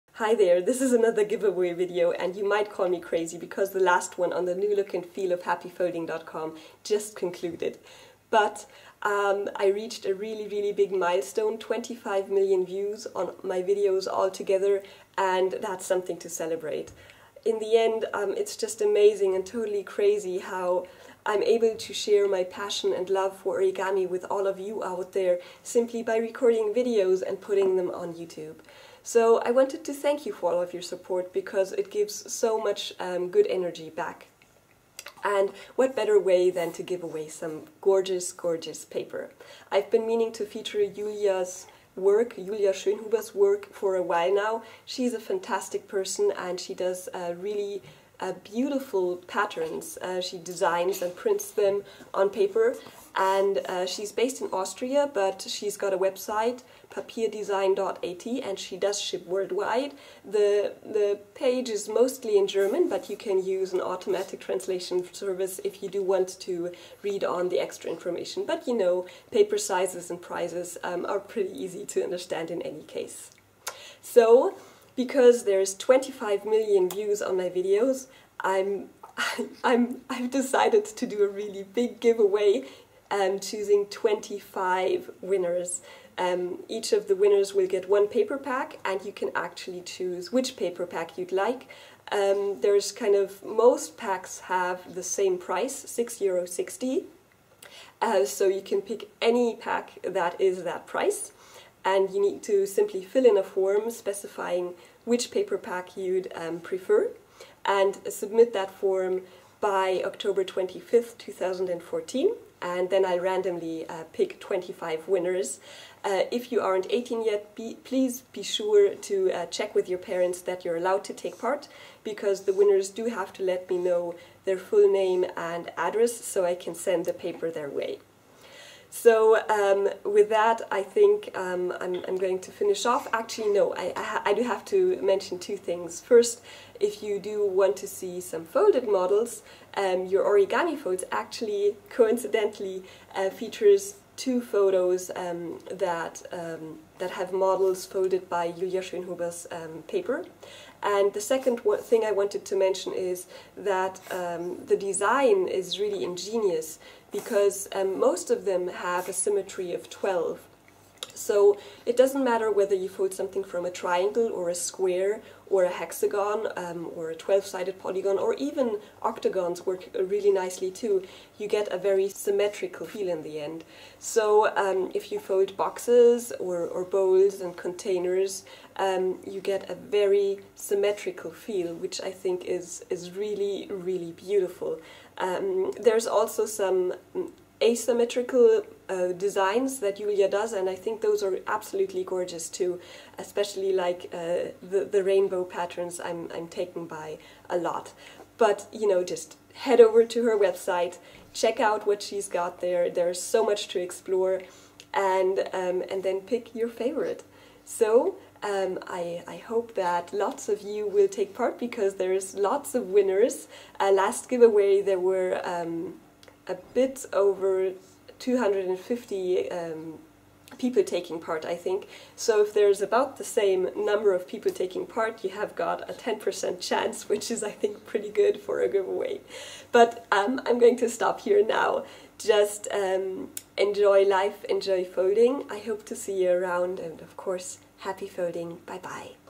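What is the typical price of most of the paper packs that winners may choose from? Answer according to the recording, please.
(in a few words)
€6.60.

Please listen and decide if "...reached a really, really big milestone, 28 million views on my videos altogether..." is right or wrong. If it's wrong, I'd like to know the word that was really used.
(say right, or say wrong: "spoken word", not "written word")
wrong: "25", not "28".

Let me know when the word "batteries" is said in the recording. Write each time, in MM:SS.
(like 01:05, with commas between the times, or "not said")
not said.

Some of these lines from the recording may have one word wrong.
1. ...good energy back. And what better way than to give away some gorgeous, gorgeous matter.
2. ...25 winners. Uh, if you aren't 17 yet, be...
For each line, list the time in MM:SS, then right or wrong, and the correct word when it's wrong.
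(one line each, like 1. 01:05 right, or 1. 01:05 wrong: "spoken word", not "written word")
1. 00:33 wrong: "paper", not "matter"
2. 01:54 wrong: "18", not "17".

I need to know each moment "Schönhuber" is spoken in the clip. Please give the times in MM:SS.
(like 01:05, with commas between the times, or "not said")
00:42, 02:28.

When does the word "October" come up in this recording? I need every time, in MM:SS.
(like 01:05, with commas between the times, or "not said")
01:50.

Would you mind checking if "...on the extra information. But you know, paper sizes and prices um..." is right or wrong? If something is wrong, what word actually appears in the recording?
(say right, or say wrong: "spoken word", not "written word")
right.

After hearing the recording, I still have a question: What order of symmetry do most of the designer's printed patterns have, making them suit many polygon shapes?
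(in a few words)
12.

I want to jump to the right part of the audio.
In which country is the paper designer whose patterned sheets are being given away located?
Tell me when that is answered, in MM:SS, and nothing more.
00:54.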